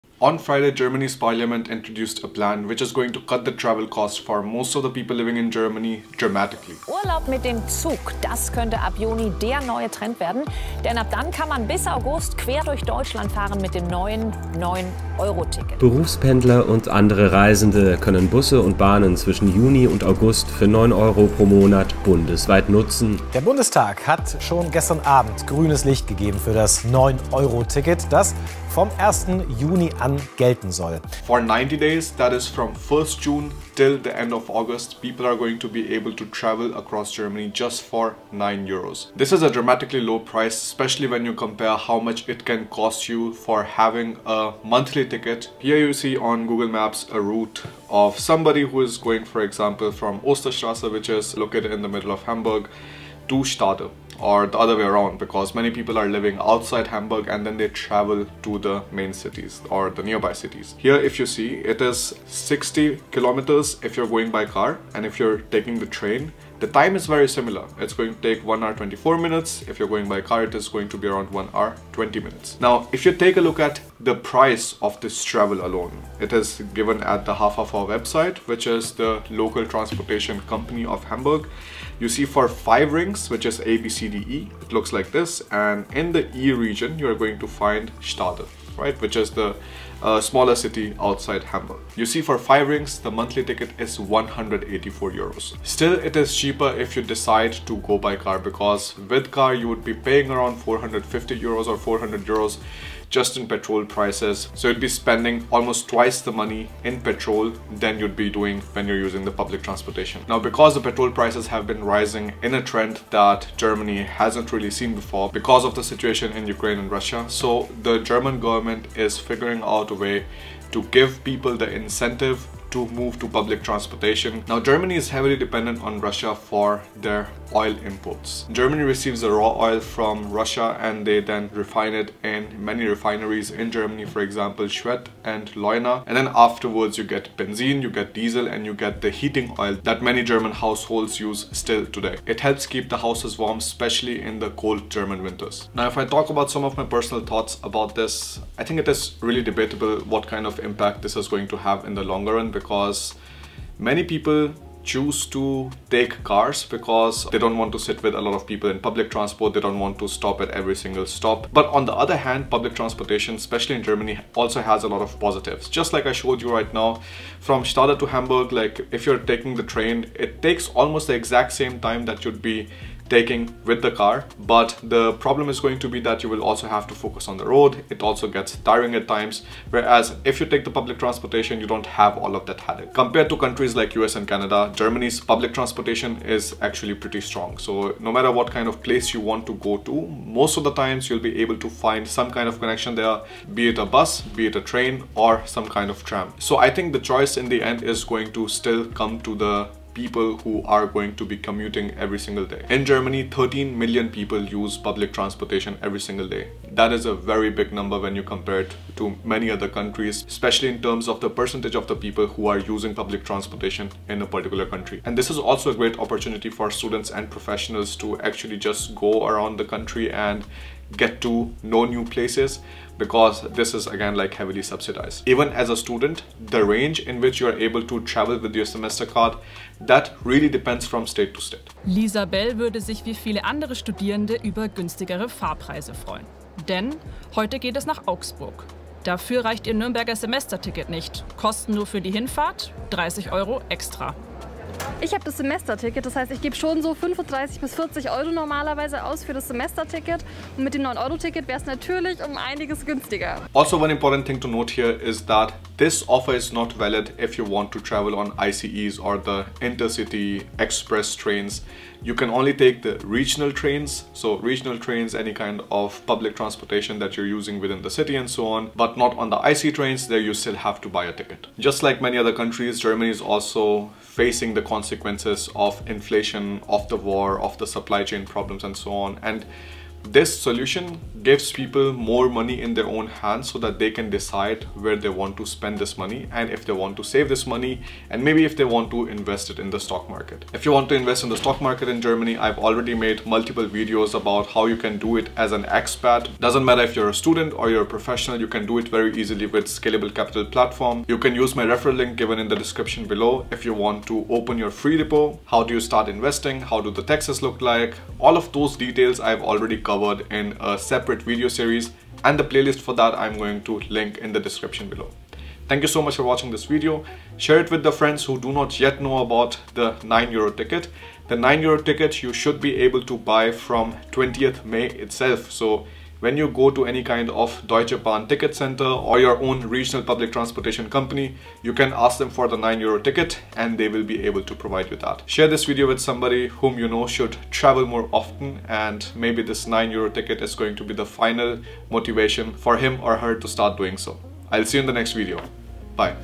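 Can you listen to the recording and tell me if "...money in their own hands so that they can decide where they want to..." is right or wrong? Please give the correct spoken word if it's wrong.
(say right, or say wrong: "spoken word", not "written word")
right.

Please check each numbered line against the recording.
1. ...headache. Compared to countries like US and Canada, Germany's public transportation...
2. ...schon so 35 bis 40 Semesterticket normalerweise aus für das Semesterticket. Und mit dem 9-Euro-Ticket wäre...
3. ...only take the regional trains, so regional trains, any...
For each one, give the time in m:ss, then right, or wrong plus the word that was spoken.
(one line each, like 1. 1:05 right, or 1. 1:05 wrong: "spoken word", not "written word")
1. 3:02 right
2. 4:06 wrong: "Euro", not "Semesterticket"
3. 4:22 right.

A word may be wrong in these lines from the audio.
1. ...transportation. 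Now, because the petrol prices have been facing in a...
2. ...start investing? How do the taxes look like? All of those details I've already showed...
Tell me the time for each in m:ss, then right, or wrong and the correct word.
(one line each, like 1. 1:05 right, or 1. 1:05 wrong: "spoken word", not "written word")
1. 1:49 wrong: "rising", not "facing"
2. 5:05 wrong: "covered", not "showed".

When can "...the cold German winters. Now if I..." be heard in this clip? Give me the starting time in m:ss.
2:24.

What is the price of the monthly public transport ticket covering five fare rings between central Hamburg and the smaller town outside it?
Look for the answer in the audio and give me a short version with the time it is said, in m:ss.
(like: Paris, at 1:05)
184 euros, at 1:33.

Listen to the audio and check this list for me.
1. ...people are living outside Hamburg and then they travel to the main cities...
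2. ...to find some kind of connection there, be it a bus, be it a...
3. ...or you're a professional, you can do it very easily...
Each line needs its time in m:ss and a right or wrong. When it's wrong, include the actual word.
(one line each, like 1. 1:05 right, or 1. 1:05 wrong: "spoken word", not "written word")
1. 0:55 right
2. 3:11 right
3. 4:57 right.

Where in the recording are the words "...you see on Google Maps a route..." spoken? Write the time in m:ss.
0:45.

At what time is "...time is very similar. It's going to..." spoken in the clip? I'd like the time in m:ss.
1:06.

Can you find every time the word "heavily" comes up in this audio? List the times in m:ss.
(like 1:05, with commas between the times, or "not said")
2:05, 3:44.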